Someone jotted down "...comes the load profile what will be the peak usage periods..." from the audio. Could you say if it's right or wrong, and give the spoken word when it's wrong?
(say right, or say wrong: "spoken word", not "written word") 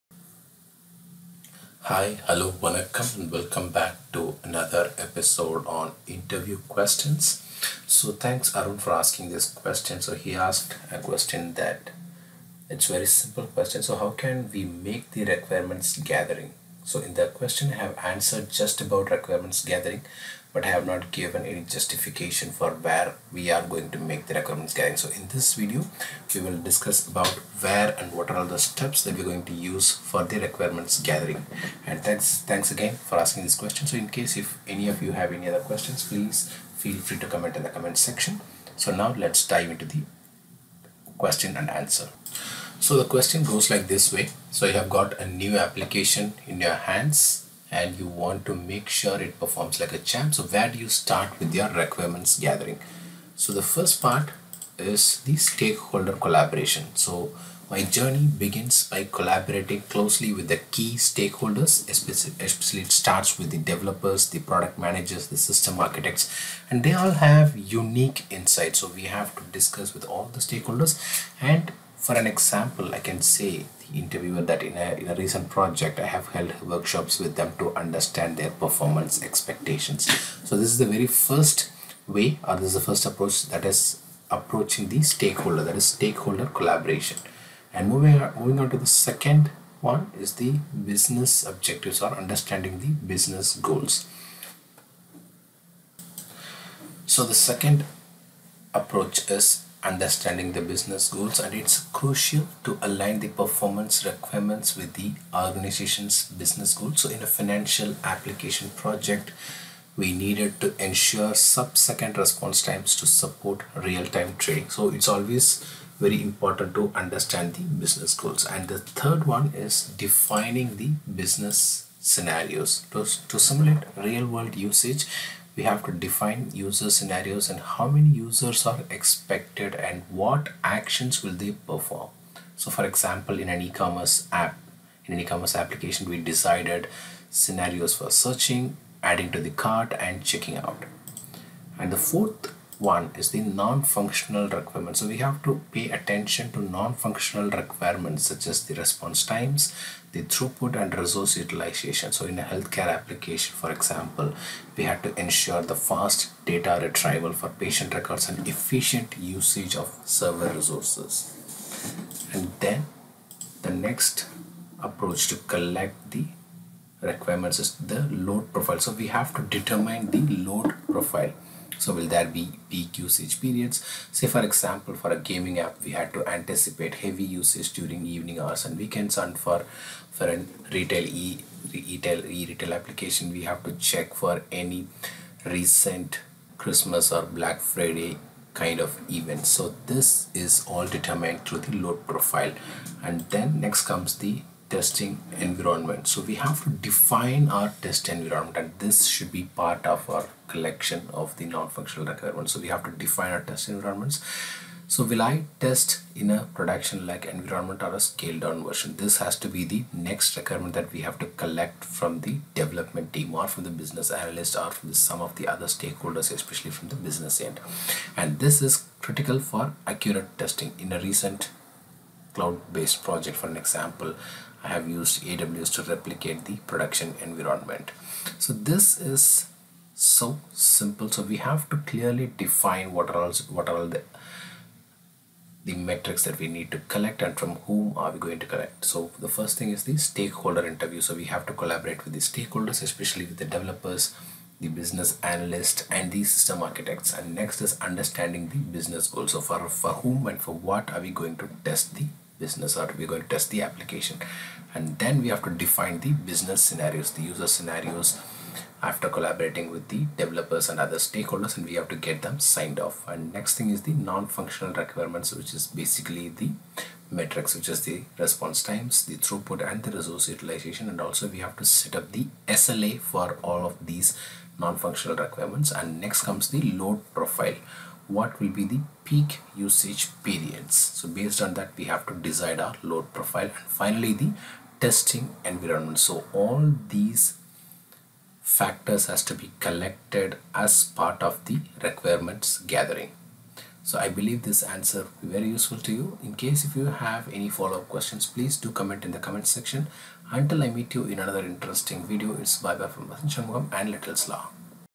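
right.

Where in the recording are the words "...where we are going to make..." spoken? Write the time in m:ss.
0:22.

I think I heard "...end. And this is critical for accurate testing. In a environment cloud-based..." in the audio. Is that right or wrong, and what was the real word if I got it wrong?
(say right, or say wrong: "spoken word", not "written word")
wrong: "recent", not "environment".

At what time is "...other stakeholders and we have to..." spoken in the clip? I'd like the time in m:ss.
4:20.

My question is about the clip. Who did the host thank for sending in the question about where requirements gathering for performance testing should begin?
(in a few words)
Arun.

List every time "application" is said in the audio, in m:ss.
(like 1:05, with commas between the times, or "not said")
0:45, 1:48, 2:15, 2:32, 3:02, 4:13.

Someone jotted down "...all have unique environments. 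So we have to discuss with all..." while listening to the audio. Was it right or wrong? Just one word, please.
wrong.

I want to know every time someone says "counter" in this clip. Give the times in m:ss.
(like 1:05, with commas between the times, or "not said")
not said.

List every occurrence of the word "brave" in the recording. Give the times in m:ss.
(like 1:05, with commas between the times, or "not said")
not said.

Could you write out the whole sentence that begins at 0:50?
So where do you start with your requirements gathering?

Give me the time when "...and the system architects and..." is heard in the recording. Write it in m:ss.
4:05.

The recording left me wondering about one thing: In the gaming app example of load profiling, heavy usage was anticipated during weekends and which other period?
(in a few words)
evening hours.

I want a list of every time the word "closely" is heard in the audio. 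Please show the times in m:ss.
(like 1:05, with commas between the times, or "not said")
0:59.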